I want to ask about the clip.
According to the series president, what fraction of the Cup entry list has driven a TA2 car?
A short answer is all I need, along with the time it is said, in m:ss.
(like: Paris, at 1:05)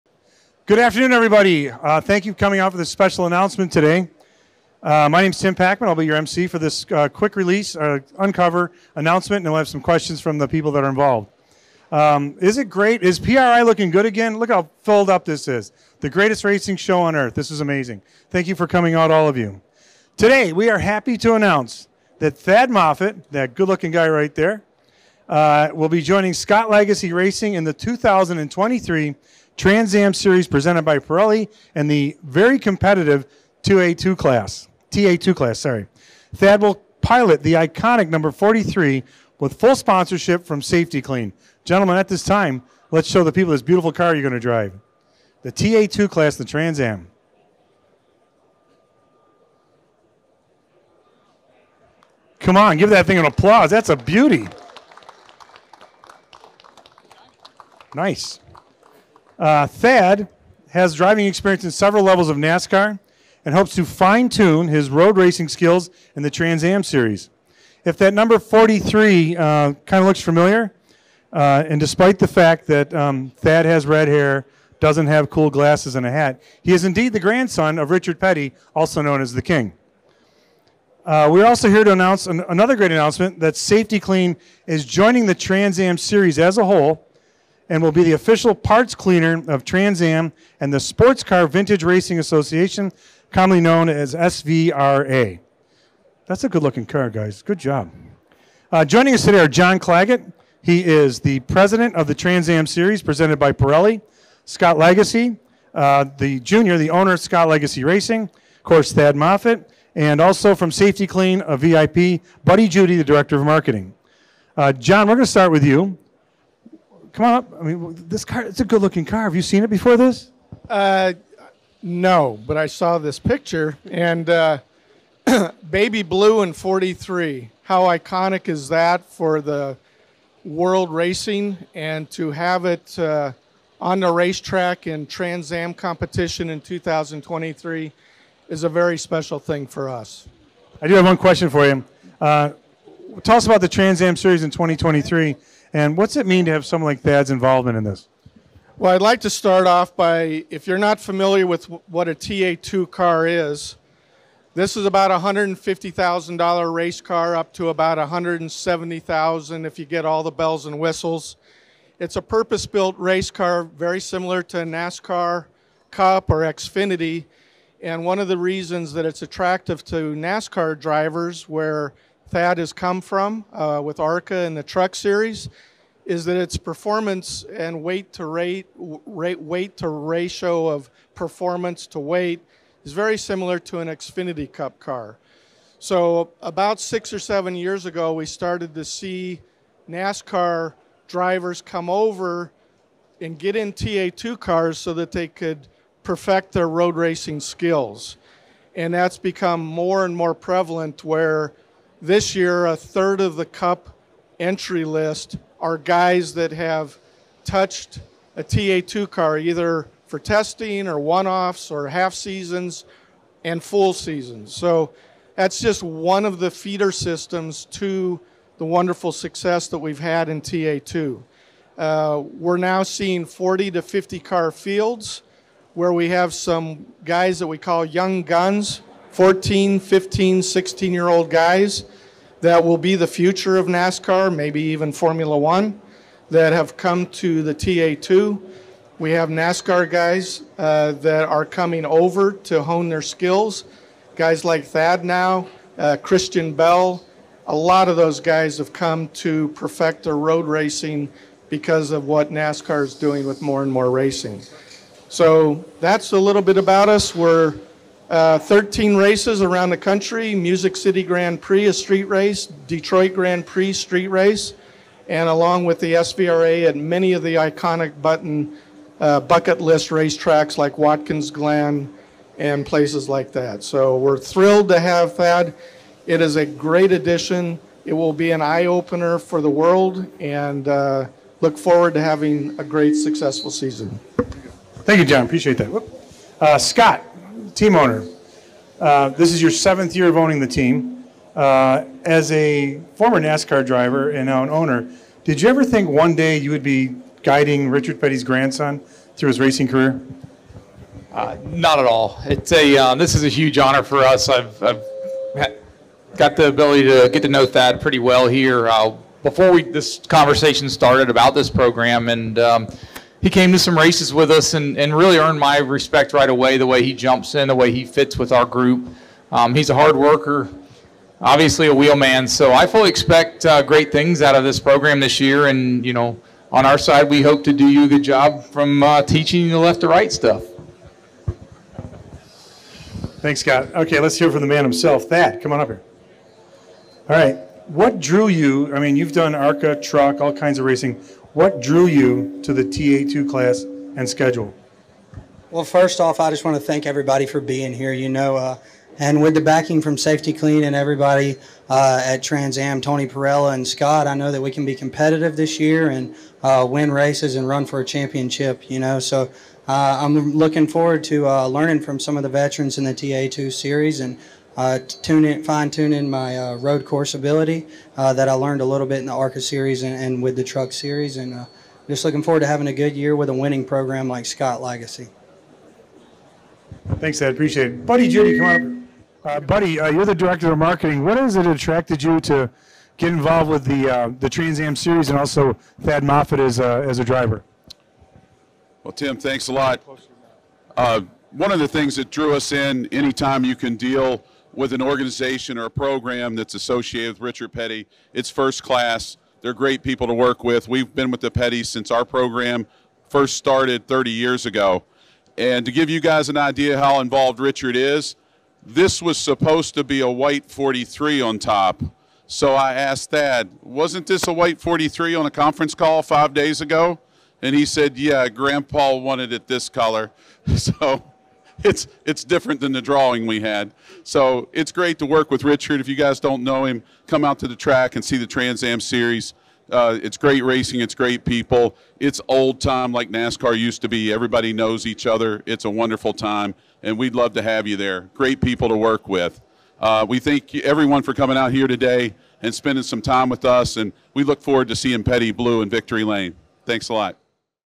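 a third, at 3:22.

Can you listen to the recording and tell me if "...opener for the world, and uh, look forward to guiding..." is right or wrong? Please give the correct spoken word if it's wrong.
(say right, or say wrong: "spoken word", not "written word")
wrong: "having", not "guiding".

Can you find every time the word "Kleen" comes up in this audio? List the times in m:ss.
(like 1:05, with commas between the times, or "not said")
0:40, 1:23, 1:50, 5:49.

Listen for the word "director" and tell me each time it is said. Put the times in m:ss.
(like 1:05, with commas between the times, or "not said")
1:53, 6:20.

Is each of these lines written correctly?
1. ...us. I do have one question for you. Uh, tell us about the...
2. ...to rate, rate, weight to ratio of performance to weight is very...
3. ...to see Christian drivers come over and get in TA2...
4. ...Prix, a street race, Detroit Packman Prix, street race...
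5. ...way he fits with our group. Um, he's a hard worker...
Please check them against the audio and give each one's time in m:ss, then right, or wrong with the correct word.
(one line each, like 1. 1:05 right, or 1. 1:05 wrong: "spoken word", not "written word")
1. 2:19 right
2. 2:58 right
3. 3:08 wrong: "NASCAR", not "Christian"
4. 4:21 wrong: "Grand", not "Packman"
5. 5:17 right.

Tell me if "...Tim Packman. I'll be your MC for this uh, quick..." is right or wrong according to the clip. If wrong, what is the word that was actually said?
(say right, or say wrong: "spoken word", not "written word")
right.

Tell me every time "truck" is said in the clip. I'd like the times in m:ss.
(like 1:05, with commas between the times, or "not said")
2:54, 5:39, 6:10.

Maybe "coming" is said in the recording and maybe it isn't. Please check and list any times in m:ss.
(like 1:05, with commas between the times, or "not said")
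0:02, 0:18, 4:01, 7:21.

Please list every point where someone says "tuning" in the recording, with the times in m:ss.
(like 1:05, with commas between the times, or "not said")
6:05.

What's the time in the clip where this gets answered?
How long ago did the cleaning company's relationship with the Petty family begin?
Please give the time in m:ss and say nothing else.
6:43.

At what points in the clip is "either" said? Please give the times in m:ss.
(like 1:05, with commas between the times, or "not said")
3:29.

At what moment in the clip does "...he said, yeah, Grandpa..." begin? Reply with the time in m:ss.
6:57.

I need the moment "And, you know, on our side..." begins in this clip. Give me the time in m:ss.
5:25.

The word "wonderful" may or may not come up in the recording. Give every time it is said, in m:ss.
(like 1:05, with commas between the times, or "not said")
3:38, 7:15.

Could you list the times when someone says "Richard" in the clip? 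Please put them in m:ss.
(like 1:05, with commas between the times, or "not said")
1:17, 4:57, 6:37, 6:47, 7:05.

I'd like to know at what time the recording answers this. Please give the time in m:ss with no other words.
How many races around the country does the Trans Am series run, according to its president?
4:18.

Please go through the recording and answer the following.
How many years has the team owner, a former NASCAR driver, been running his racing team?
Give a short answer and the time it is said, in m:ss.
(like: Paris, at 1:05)
7, at 4:49.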